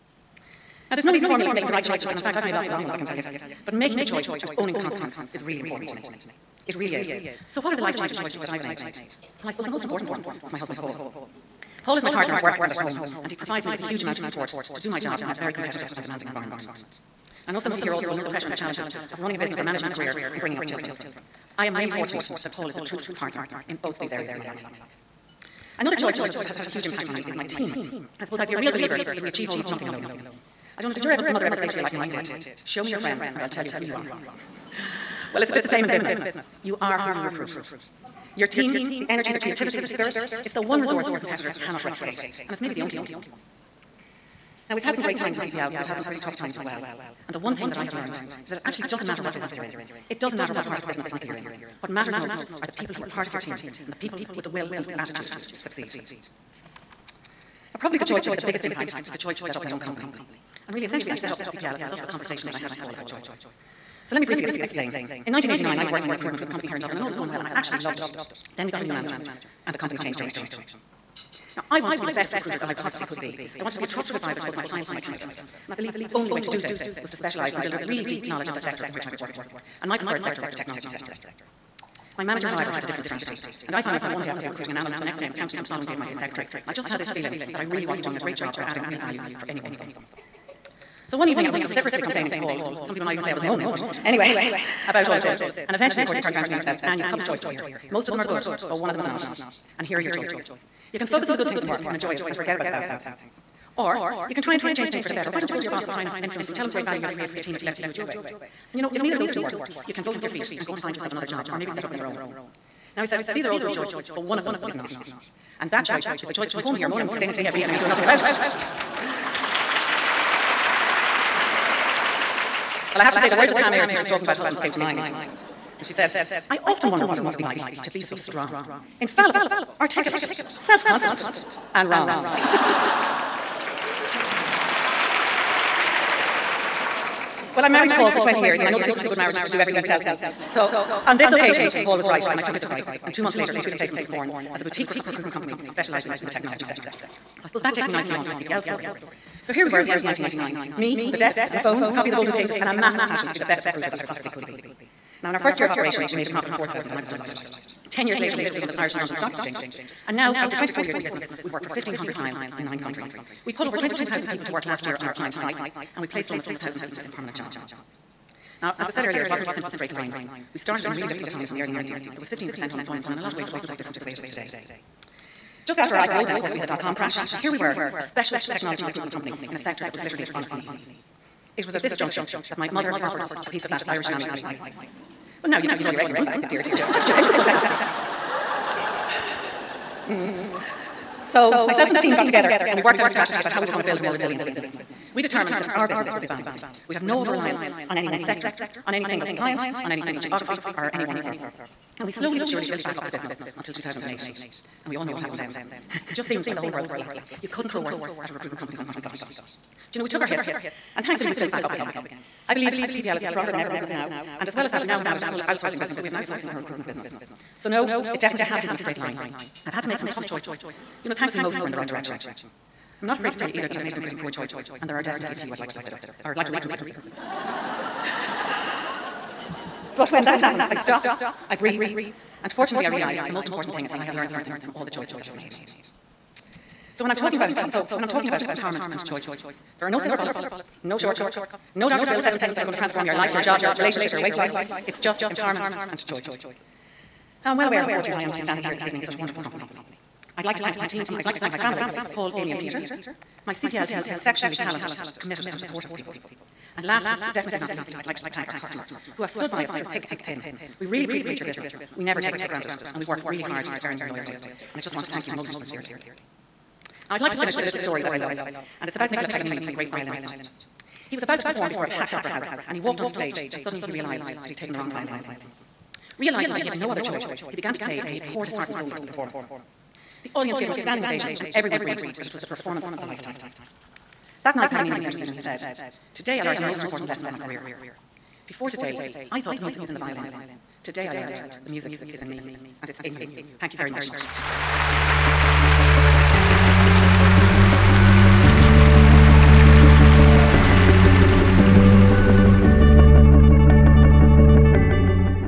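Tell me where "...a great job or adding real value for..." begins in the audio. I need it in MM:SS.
01:28.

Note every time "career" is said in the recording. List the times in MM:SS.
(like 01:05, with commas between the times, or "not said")
00:19, 04:47.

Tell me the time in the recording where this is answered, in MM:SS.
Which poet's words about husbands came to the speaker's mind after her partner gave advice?
02:03.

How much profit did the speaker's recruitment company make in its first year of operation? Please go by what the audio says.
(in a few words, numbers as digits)
4,000.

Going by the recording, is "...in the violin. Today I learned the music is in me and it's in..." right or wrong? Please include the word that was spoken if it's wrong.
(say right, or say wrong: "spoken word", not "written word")
right.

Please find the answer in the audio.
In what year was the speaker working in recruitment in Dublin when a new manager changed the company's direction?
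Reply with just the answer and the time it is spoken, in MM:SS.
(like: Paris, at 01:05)
1989, at 01:05.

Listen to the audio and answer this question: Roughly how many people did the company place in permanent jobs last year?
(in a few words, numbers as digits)
6,000.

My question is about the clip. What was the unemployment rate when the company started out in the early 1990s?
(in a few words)
15%.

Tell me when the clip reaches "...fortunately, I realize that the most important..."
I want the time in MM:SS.
03:52.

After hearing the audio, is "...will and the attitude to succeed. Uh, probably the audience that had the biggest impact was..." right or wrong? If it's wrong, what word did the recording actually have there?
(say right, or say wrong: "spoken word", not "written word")
wrong: "choice", not "audience".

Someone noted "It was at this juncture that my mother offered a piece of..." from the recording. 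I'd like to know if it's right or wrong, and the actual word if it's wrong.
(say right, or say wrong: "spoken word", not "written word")
right.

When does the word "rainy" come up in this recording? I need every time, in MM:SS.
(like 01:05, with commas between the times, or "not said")
not said.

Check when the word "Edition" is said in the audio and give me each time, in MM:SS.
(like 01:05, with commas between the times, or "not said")
not said.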